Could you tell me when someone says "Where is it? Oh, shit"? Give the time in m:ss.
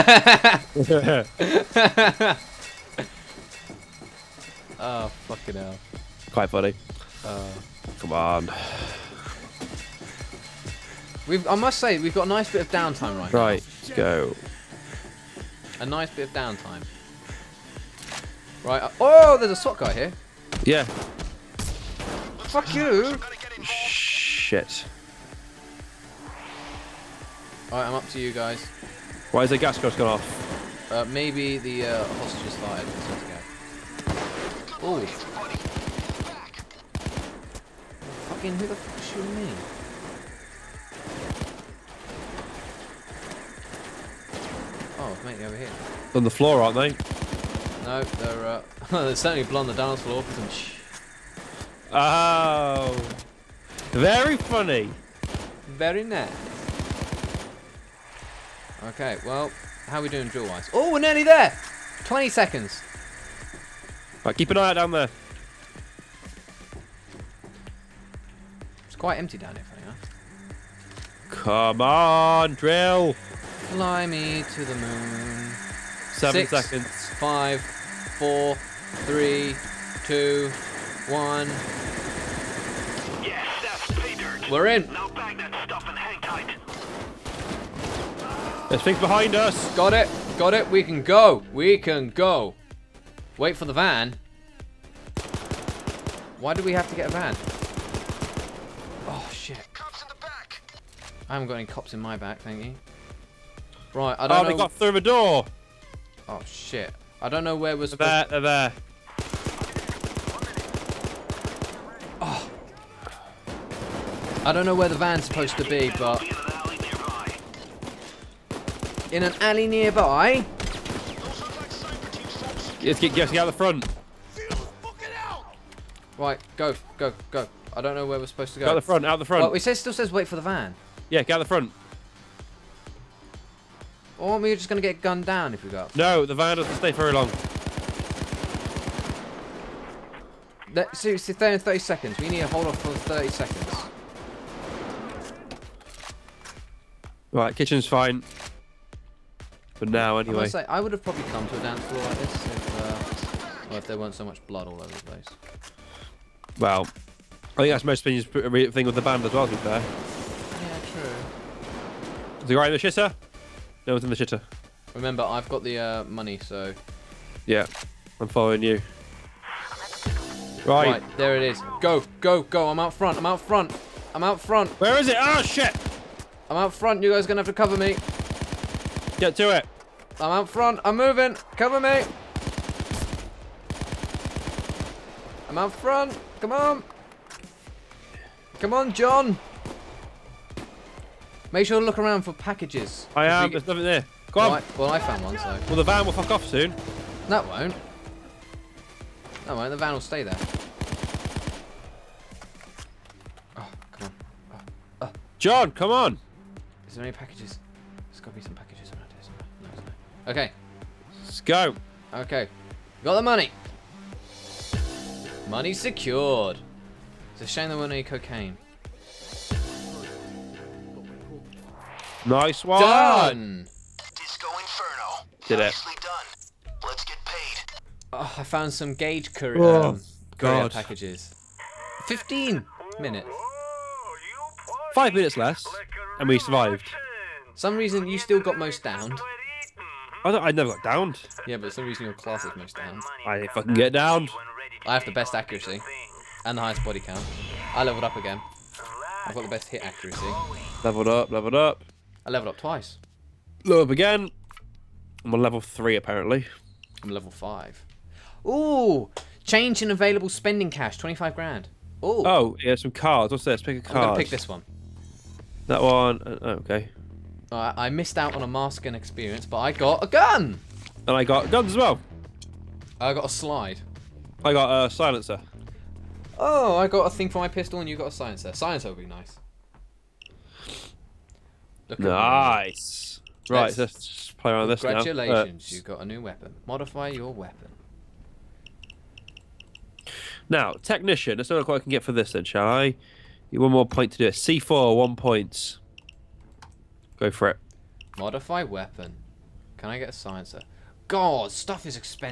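2:54.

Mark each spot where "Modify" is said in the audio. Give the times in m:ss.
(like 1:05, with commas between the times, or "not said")
4:46, 4:58.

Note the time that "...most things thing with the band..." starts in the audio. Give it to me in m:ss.
2:37.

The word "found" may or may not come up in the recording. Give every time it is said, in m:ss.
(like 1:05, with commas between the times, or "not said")
3:14, 3:48.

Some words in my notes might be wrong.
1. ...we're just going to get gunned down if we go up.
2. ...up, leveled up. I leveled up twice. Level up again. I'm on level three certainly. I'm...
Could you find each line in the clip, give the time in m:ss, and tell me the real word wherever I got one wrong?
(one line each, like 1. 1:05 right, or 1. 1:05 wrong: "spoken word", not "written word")
1. 2:14 right
2. 4:11 wrong: "apparently", not "certainly".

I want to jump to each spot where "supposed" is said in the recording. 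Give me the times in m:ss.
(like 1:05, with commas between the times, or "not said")
1:47, 1:55, 2:08.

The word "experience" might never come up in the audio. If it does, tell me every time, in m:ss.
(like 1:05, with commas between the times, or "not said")
4:28.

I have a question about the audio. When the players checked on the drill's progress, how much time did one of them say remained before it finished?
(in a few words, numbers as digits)
20 seconds.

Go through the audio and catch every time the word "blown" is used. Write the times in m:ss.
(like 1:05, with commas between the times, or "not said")
0:49.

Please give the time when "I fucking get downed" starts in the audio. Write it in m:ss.
4:03.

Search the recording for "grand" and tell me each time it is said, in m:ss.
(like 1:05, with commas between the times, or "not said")
4:21.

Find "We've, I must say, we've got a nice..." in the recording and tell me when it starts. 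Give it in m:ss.
0:11.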